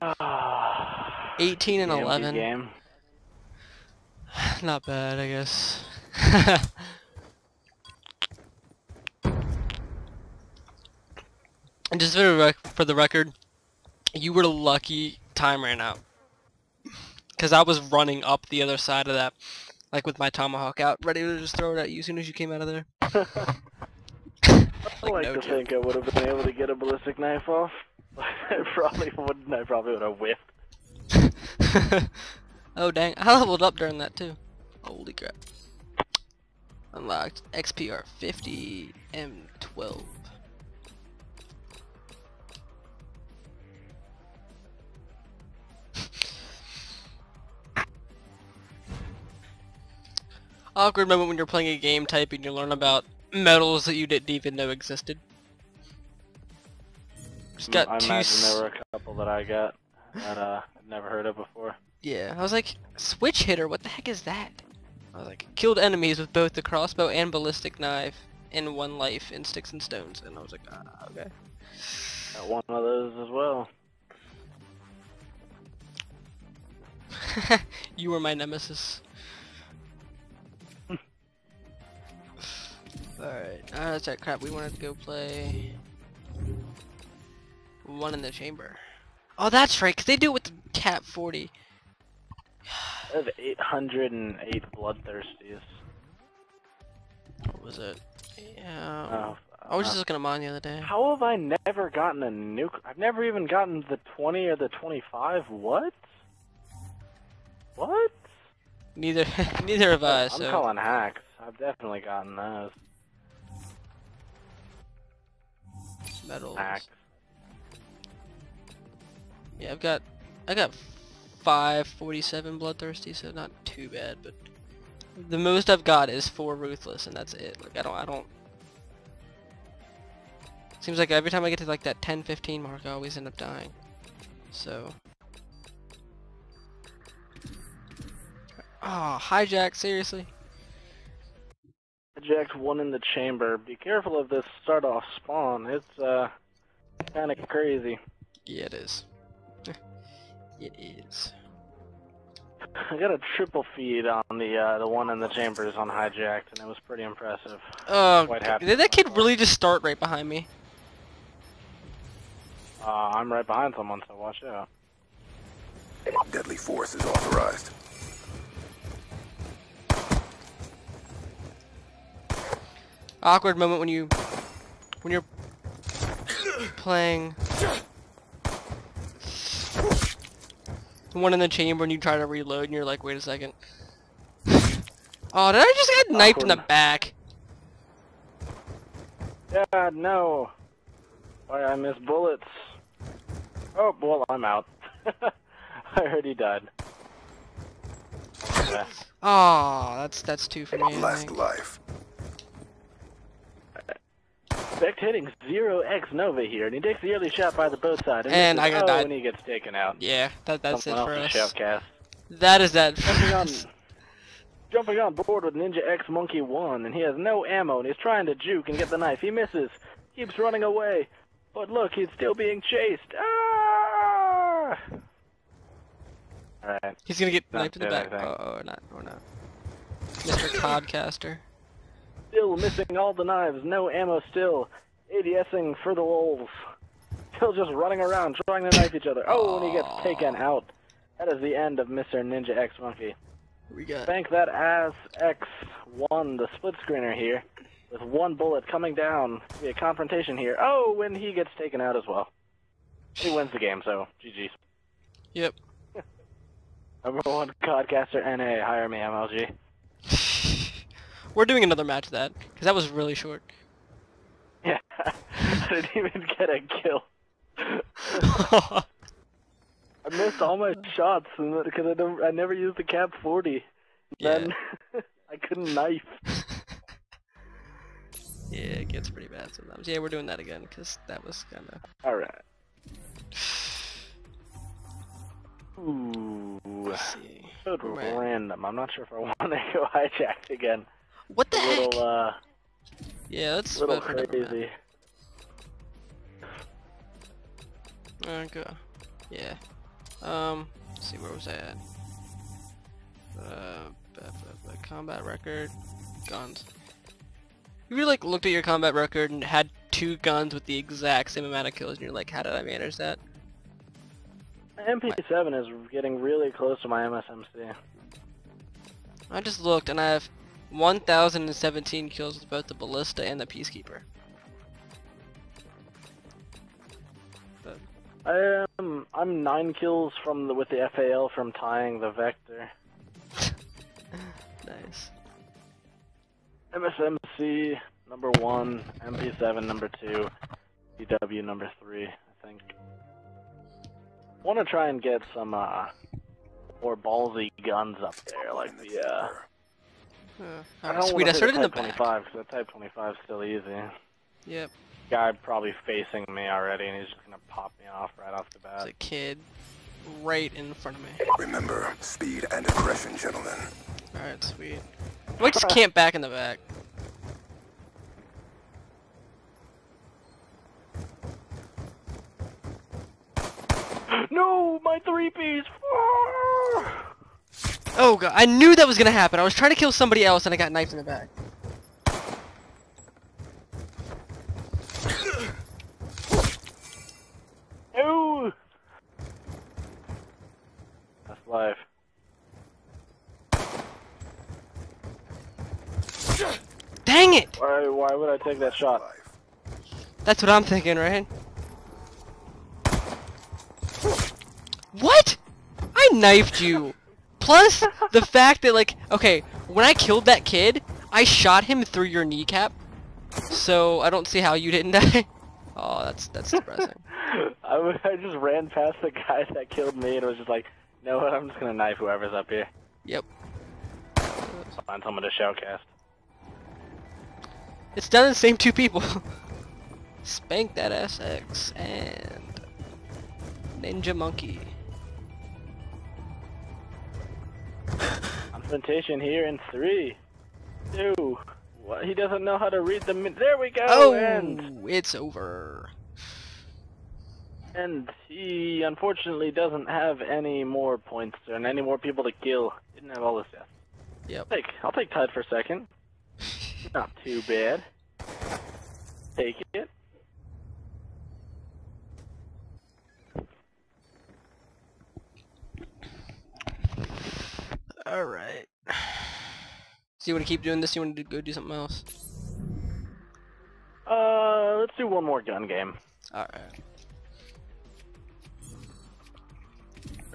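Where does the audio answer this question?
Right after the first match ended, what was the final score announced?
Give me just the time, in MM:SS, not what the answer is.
00:01.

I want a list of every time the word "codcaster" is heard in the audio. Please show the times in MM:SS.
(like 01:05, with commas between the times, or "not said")
03:50, 04:17.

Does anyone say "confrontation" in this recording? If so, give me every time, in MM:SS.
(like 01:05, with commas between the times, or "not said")
04:09.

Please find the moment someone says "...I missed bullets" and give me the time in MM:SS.
03:11.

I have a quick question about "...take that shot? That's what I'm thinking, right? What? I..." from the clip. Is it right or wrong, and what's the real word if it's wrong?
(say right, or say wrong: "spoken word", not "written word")
right.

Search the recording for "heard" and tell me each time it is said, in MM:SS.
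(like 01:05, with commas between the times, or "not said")
01:01, 03:16.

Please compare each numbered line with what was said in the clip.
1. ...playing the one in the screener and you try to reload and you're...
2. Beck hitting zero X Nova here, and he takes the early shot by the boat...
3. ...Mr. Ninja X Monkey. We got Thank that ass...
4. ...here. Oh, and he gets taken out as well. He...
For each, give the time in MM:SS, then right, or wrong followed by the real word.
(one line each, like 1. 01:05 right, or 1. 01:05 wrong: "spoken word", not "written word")
1. 02:56 wrong: "chamber", not "screener"
2. 03:24 right
3. 04:01 right
4. 04:10 right.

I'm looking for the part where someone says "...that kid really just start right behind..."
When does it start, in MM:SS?
02:38.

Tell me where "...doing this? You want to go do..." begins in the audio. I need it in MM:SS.
07:50.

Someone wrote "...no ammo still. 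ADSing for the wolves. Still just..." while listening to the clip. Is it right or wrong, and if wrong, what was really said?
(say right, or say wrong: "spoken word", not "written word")
right.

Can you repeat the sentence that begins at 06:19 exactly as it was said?
I was trying to kill somebody else and I got knifed in the back.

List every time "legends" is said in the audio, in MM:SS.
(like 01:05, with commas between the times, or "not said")
not said.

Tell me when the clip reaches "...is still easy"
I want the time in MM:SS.
05:53.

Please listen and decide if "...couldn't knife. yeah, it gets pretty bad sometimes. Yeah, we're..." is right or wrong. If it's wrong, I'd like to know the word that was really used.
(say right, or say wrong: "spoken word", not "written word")
right.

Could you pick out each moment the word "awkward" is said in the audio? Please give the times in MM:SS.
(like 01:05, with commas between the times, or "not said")
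00:50, 02:53.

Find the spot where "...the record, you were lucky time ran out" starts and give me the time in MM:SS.
00:12.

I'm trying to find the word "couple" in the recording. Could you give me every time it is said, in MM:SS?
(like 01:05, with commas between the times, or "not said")
00:58.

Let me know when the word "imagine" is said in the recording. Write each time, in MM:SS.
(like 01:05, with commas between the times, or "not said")
00:58.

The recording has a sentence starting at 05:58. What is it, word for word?
It's a kid right in front of me.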